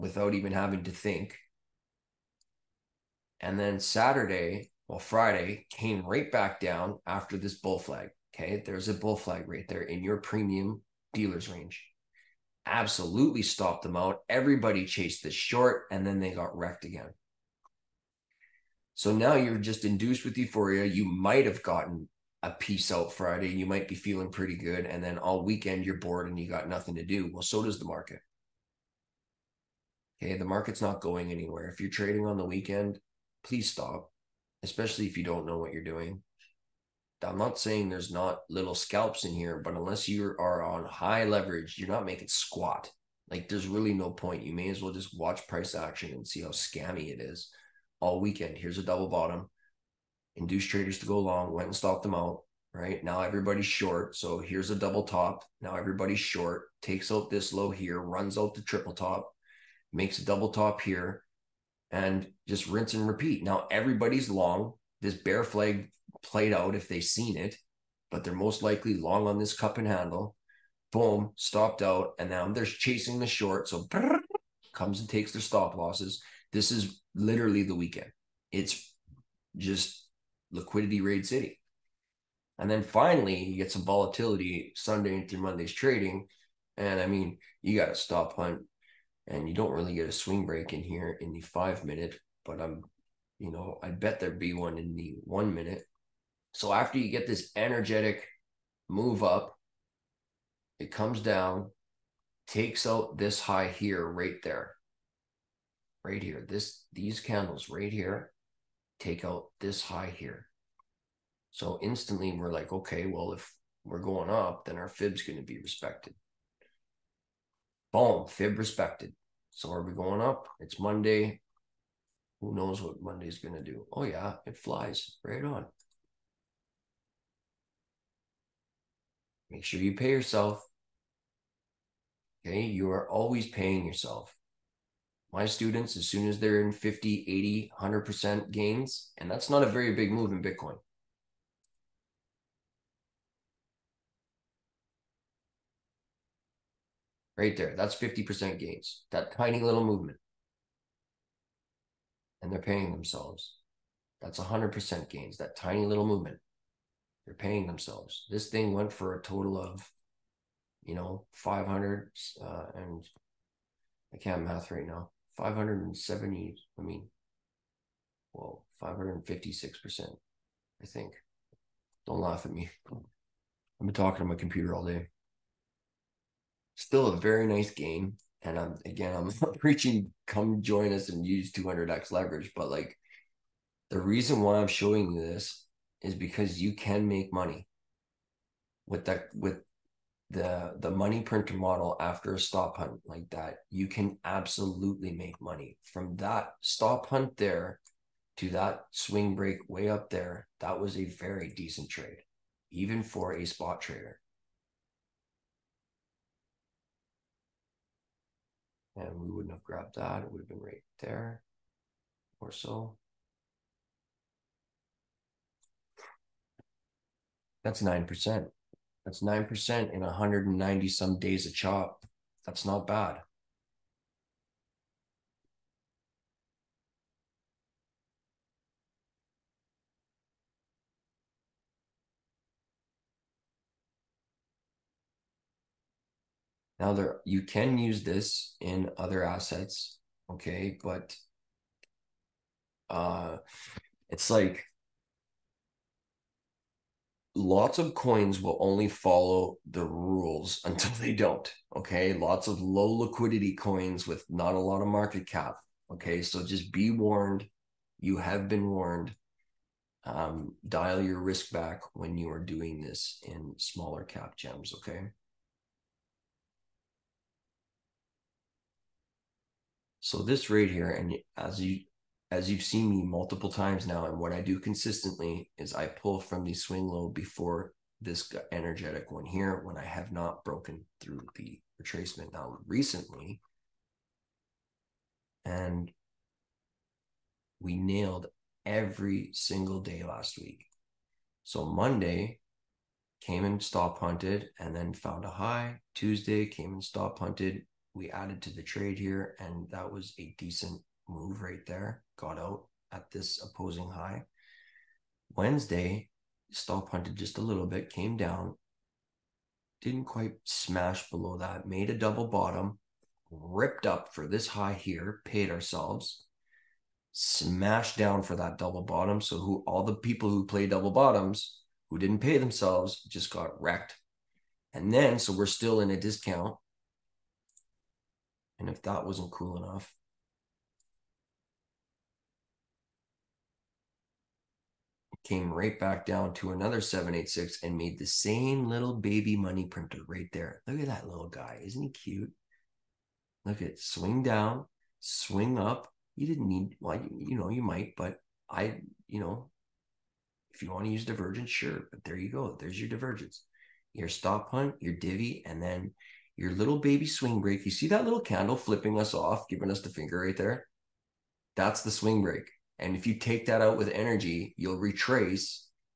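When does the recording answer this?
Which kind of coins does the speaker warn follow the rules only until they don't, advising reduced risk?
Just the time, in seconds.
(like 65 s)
252 s.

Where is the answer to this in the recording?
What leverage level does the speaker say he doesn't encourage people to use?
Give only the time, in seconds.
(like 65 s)
181 s.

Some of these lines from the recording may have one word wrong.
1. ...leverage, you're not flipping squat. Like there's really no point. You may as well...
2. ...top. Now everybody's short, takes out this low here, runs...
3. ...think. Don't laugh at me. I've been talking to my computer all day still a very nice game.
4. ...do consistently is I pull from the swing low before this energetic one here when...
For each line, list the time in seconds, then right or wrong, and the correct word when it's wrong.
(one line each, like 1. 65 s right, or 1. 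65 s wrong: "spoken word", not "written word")
1. 41 s wrong: "making", not "flipping"
2. 55 s right
3. 170 s right
4. 274 s right.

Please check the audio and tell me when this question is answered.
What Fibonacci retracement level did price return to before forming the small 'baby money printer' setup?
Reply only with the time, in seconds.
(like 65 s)
336 s.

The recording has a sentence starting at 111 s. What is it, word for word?
So instantly we're like, okay, well if we're going up, then our fib's going to be respected.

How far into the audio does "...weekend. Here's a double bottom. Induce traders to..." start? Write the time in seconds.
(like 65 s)
48 s.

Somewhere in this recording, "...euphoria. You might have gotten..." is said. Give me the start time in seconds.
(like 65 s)
20 s.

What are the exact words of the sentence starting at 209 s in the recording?
and we wouldn't have grabbed that.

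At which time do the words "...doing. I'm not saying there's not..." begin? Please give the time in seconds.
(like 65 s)
35 s.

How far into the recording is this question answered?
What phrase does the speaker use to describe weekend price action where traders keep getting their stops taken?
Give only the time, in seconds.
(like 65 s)
80 s.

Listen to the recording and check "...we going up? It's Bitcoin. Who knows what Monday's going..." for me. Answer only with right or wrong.
wrong.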